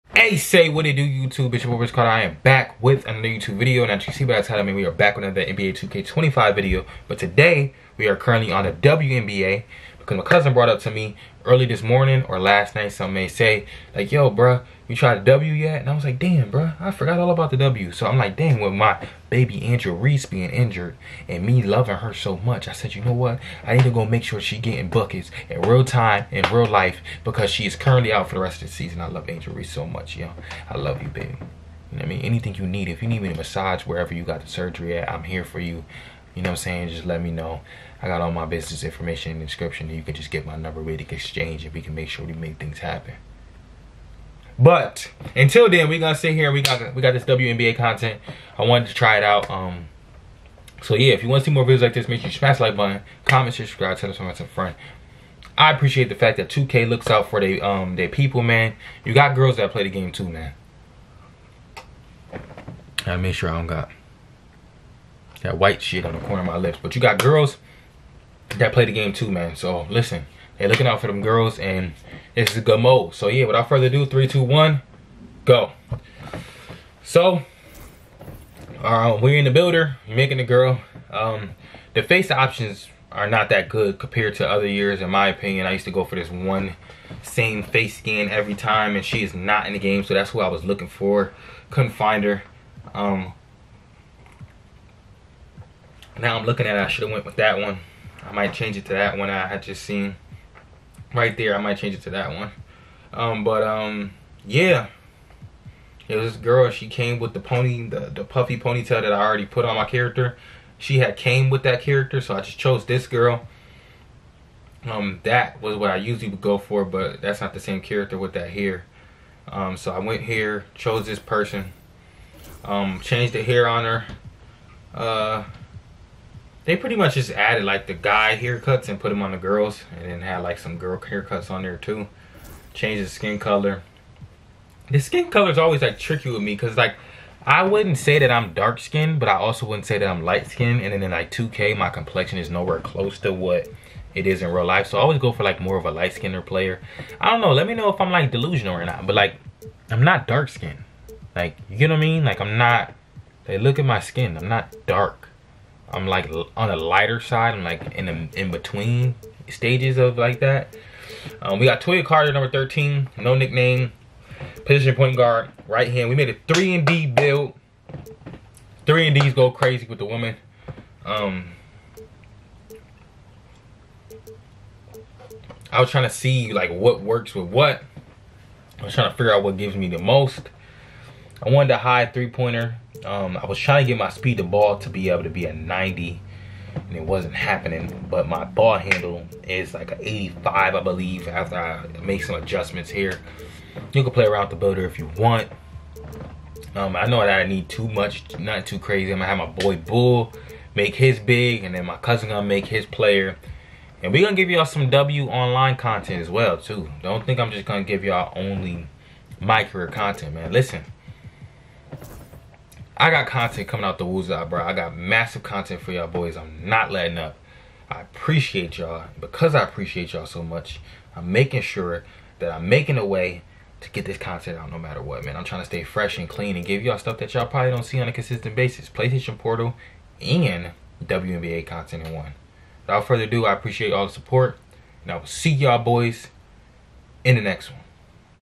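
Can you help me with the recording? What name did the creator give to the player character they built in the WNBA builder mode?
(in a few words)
Toya Carter.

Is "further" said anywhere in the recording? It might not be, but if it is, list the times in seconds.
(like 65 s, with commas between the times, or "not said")
73 s, 233 s.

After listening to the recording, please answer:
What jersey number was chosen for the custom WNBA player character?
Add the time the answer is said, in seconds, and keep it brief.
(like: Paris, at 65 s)
13, at 162 s.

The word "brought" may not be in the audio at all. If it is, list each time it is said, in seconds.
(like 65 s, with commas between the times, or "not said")
10 s.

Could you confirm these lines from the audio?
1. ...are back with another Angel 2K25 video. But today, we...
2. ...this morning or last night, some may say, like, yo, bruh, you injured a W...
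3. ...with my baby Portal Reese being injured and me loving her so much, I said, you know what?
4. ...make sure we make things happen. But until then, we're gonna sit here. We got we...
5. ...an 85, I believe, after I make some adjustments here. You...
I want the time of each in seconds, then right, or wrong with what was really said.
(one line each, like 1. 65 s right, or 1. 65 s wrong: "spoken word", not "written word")
1. 4 s wrong: "NBA", not "Angel"
2. 11 s wrong: "tried", not "injured"
3. 18 s wrong: "Angel", not "Portal"
4. 41 s right
5. 189 s right.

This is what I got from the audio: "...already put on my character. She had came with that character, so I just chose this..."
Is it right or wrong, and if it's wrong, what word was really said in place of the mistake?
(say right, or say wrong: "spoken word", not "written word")
right.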